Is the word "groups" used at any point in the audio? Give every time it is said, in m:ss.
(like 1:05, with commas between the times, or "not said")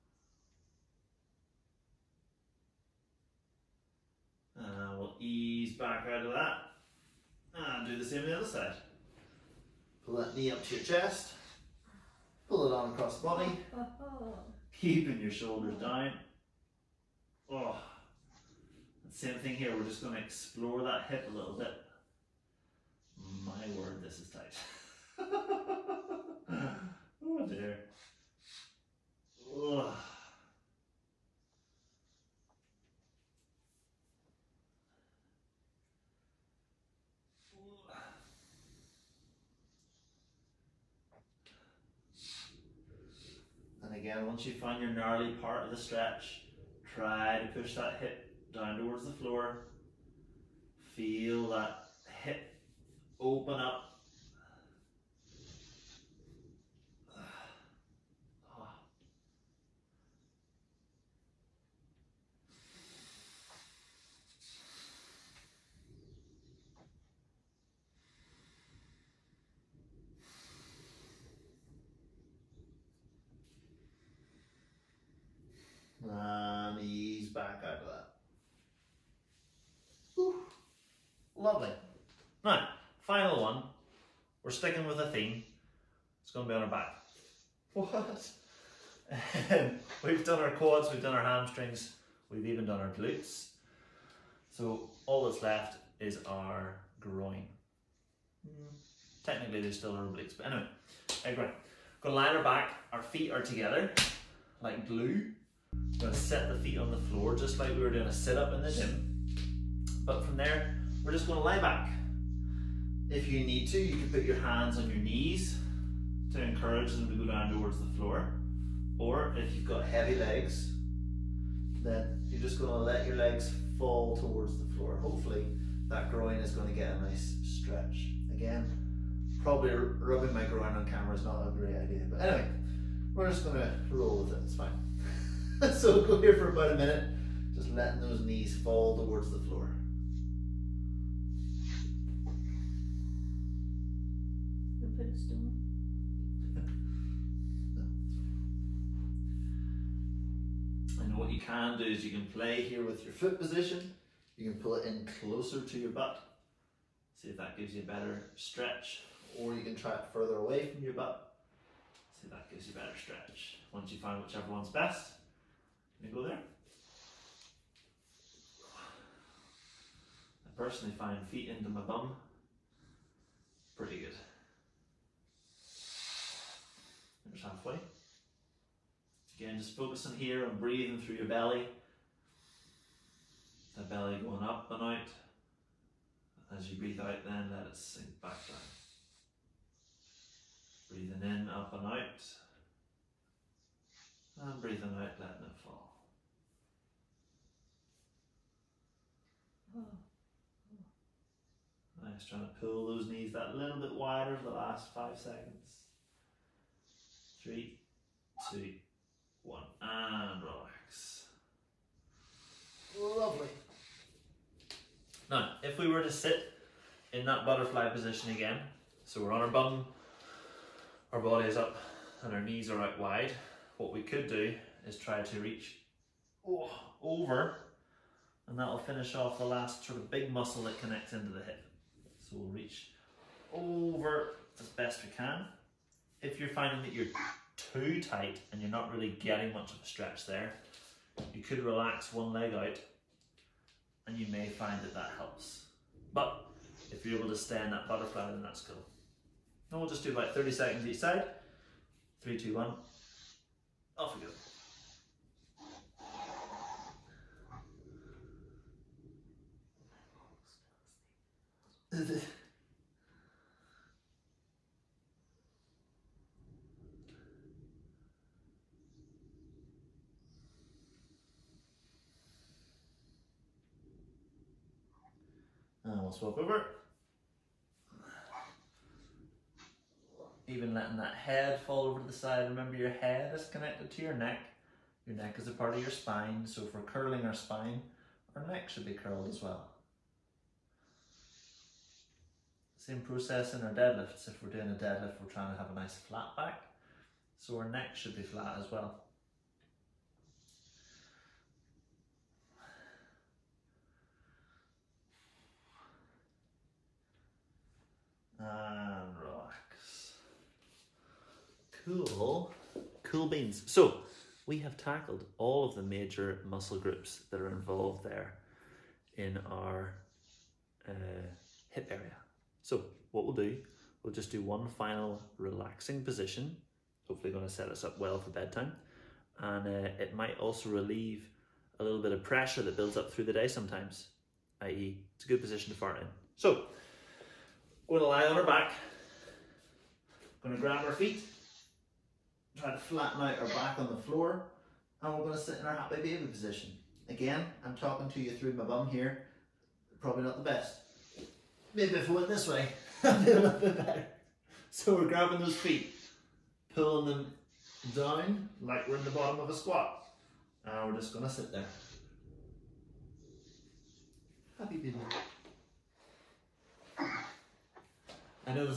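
5:16.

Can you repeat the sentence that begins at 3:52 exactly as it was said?
So we'll reach over as best we can.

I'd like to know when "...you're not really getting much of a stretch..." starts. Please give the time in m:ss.
3:58.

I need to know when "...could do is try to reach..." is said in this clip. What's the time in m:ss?
3:44.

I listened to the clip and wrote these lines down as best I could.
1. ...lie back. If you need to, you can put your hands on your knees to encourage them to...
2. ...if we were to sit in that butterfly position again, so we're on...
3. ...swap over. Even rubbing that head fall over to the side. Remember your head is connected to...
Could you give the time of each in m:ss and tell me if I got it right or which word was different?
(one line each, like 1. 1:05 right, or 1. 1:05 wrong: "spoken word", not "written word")
1. 1:51 right
2. 3:35 right
3. 4:36 wrong: "letting", not "rubbing".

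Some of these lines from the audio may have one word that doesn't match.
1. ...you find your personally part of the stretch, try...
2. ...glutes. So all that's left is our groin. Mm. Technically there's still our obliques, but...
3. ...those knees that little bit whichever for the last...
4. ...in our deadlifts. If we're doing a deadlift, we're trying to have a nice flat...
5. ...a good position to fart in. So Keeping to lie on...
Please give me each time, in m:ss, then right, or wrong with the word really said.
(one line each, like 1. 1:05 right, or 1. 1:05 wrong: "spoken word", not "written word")
1. 0:44 wrong: "gnarly", not "personally"
2. 1:32 right
3. 3:22 wrong: "wider", not "whichever"
4. 4:53 right
5. 5:35 wrong: "Going", not "Keeping".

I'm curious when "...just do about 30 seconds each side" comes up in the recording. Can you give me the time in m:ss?
4:09.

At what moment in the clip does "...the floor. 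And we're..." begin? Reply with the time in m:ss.
5:43.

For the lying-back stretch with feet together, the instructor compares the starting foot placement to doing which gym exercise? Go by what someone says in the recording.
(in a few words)
sit-up.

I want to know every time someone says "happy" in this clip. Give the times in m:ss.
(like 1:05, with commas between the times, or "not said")
5:45, 6:04.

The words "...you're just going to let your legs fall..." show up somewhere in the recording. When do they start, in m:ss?
2:02.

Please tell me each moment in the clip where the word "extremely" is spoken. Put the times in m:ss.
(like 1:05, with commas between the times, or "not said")
not said.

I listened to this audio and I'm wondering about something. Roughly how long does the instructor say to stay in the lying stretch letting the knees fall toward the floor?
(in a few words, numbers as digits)
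about a minute.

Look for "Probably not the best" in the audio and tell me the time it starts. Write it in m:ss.
5:50.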